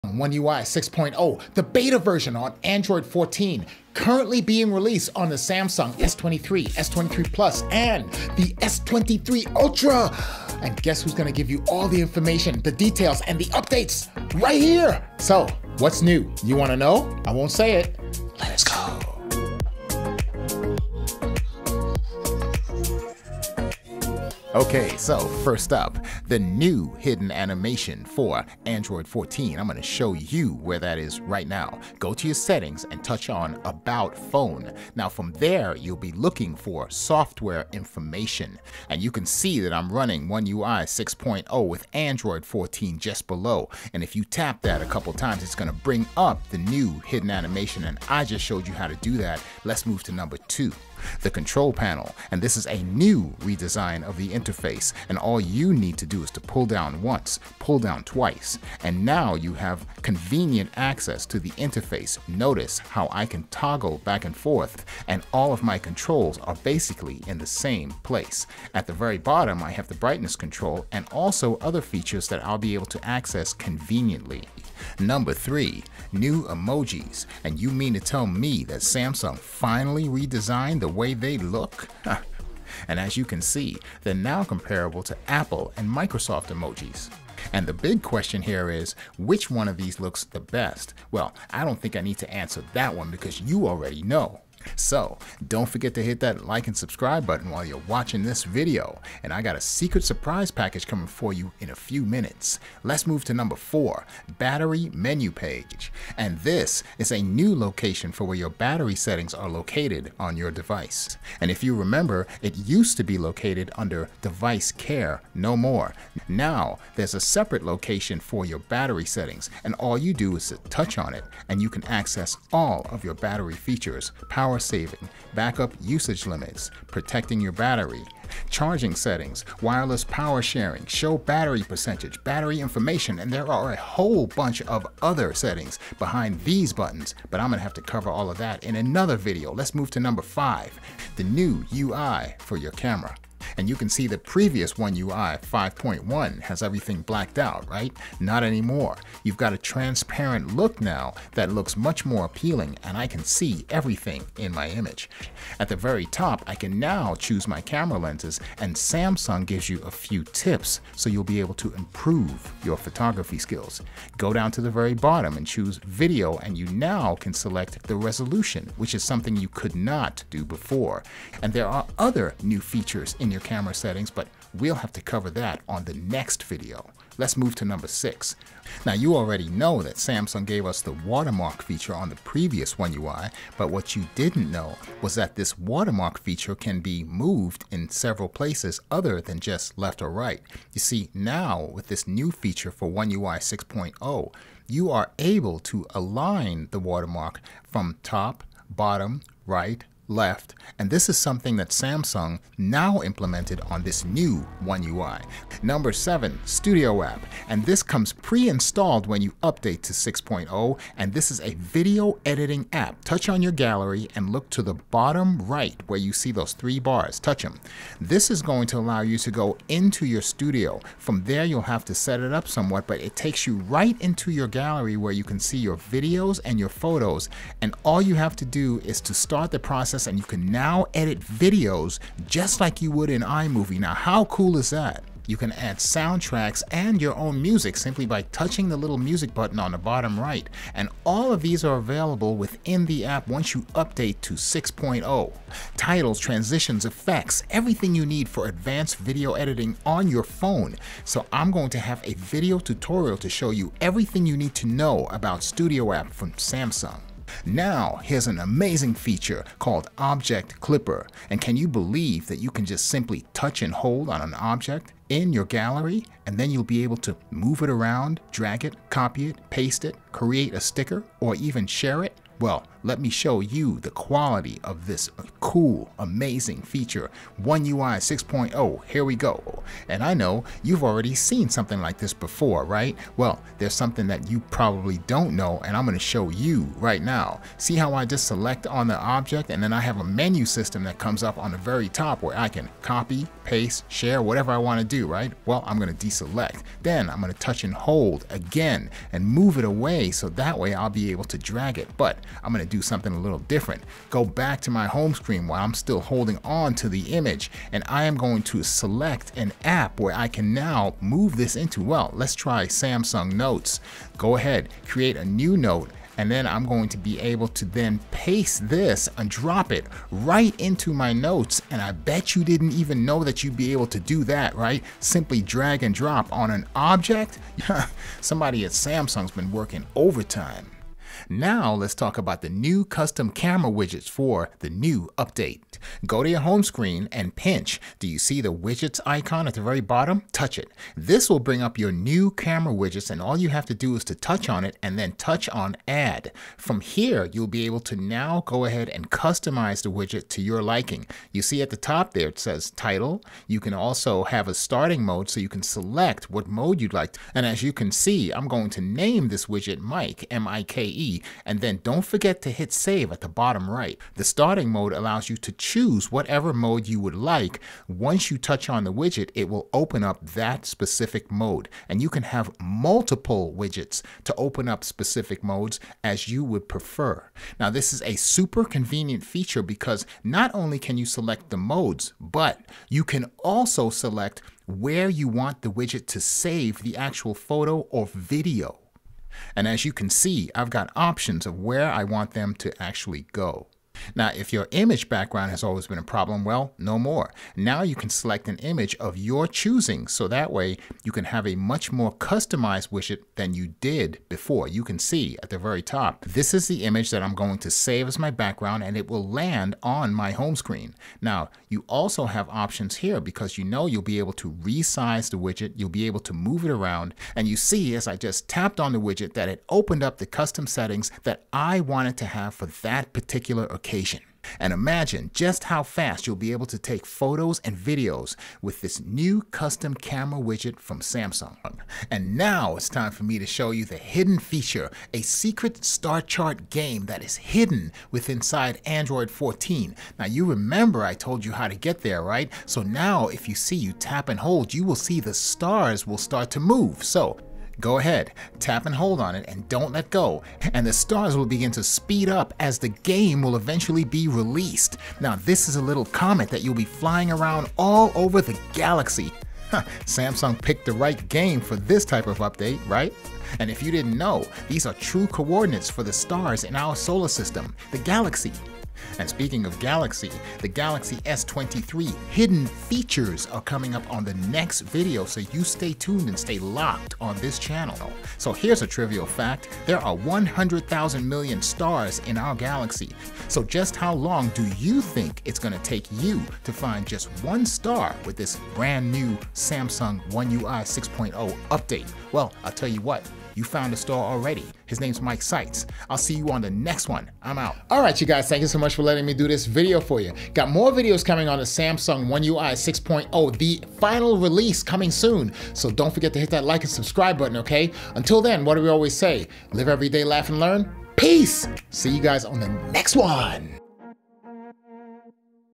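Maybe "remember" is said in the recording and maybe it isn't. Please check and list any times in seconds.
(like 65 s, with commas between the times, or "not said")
111 s, 440 s.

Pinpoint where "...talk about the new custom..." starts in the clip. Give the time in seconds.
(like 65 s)
331 s.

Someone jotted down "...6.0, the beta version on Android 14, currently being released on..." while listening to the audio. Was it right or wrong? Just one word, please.
right.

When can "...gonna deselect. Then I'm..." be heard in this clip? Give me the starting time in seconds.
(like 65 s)
295 s.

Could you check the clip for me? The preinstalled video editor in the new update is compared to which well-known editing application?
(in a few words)
iMovie.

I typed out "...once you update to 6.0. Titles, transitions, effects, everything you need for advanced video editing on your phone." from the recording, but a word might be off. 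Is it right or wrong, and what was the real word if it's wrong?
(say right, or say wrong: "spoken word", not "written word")
right.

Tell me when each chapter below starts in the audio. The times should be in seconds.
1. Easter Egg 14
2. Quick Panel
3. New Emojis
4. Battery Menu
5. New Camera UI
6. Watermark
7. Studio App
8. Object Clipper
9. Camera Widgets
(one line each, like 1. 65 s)
1. 24 s
2. 50 s
3. 73 s
4. 103 s
5. 138 s
6. 177 s
7. 203 s
8. 256 s
9. 351 s.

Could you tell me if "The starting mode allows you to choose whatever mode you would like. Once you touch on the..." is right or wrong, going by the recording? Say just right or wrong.
right.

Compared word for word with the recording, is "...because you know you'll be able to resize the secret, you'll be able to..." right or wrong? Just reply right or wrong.
wrong.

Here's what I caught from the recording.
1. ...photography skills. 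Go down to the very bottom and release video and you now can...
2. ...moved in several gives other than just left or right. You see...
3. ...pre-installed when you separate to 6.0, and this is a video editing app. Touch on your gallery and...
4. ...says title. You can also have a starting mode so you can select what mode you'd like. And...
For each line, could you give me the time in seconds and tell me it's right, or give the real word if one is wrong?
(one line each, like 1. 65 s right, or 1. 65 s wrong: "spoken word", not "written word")
1. 162 s wrong: "choose", not "release"
2. 187 s wrong: "places", not "gives"
3. 208 s wrong: "update", not "separate"
4. 352 s right.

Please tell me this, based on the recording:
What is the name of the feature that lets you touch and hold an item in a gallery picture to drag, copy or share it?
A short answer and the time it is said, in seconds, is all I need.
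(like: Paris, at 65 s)
Object Clipper, at 259 s.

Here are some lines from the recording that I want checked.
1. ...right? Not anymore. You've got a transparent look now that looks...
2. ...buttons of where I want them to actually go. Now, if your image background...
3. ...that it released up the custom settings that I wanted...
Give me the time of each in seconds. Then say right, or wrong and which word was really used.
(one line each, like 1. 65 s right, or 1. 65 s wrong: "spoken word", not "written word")
1. 147 s right
2. 390 s wrong: "options", not "buttons"
3. 419 s wrong: "opened", not "released".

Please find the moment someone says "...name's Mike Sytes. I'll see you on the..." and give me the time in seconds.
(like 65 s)
494 s.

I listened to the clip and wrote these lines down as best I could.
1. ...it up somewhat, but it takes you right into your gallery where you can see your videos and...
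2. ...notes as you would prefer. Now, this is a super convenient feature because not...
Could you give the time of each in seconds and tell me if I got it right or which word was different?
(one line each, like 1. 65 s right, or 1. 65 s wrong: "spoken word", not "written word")
1. 222 s right
2. 375 s wrong: "modes", not "notes".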